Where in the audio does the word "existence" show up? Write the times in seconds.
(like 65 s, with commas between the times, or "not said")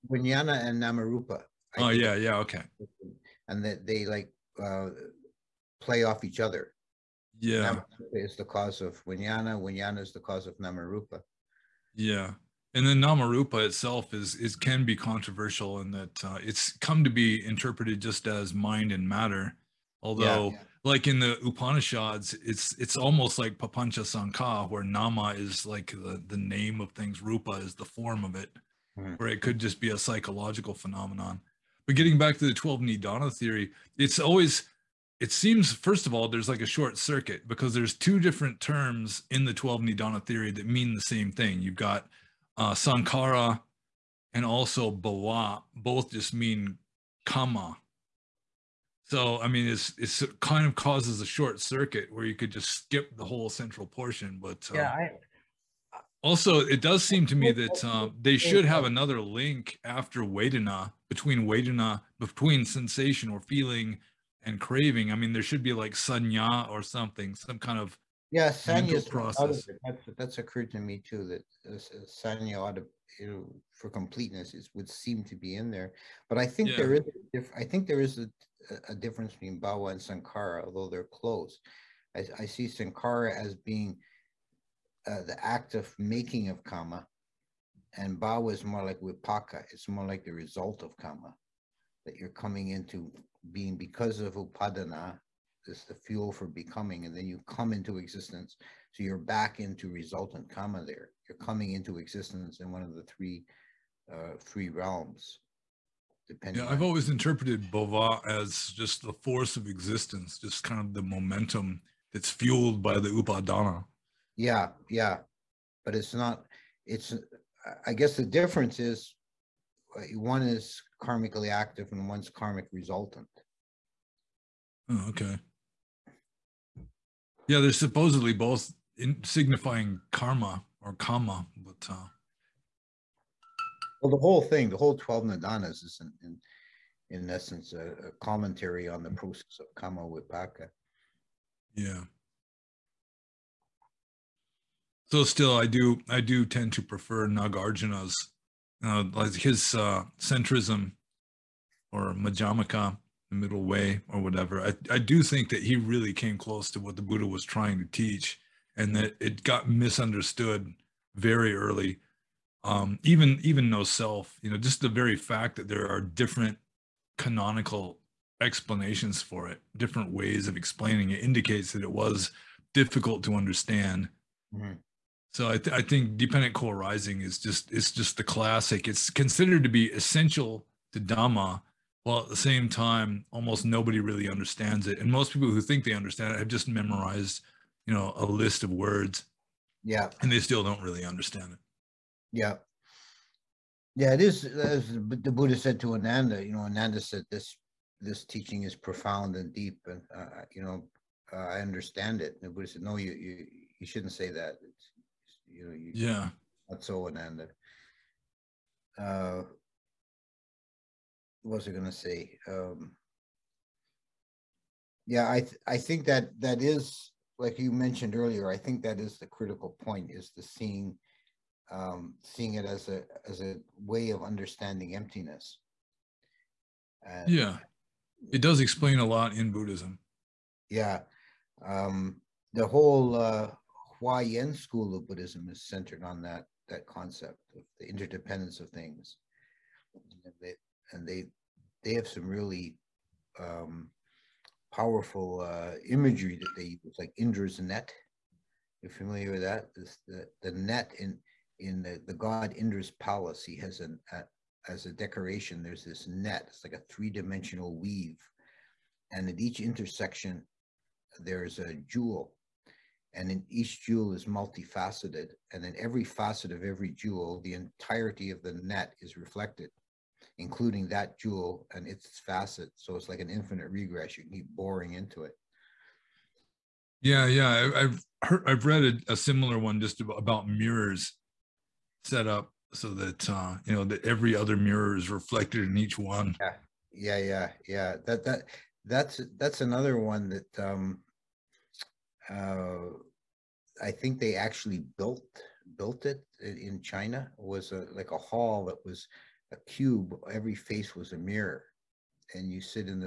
97 s, 101 s, 109 s.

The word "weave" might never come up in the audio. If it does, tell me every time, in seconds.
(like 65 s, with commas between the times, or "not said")
257 s.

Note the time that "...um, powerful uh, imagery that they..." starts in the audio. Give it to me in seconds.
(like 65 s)
243 s.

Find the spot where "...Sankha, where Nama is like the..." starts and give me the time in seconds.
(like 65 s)
24 s.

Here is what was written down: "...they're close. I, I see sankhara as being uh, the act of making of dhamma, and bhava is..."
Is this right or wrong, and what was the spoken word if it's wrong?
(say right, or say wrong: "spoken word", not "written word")
wrong: "kamma", not "dhamma".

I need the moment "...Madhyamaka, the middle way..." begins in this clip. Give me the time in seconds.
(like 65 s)
152 s.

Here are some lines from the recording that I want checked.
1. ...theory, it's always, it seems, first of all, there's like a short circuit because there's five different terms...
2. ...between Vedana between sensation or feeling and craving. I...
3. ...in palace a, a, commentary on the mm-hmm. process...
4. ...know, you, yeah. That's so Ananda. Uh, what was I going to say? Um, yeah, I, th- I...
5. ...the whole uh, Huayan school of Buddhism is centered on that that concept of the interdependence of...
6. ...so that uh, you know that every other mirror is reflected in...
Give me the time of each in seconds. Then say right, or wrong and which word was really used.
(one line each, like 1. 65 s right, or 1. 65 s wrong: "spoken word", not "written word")
1. 33 s wrong: "two", not "five"
2. 61 s right
3. 137 s wrong: "essence", not "palace"
4. 205 s right
5. 232 s right
6. 282 s right.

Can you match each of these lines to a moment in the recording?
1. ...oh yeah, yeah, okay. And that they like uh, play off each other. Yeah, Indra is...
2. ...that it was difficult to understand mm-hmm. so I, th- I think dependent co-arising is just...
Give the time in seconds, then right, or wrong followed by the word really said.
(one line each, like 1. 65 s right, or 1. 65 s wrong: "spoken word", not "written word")
1. 1 s wrong: "Namarupa", not "Indra"
2. 171 s right.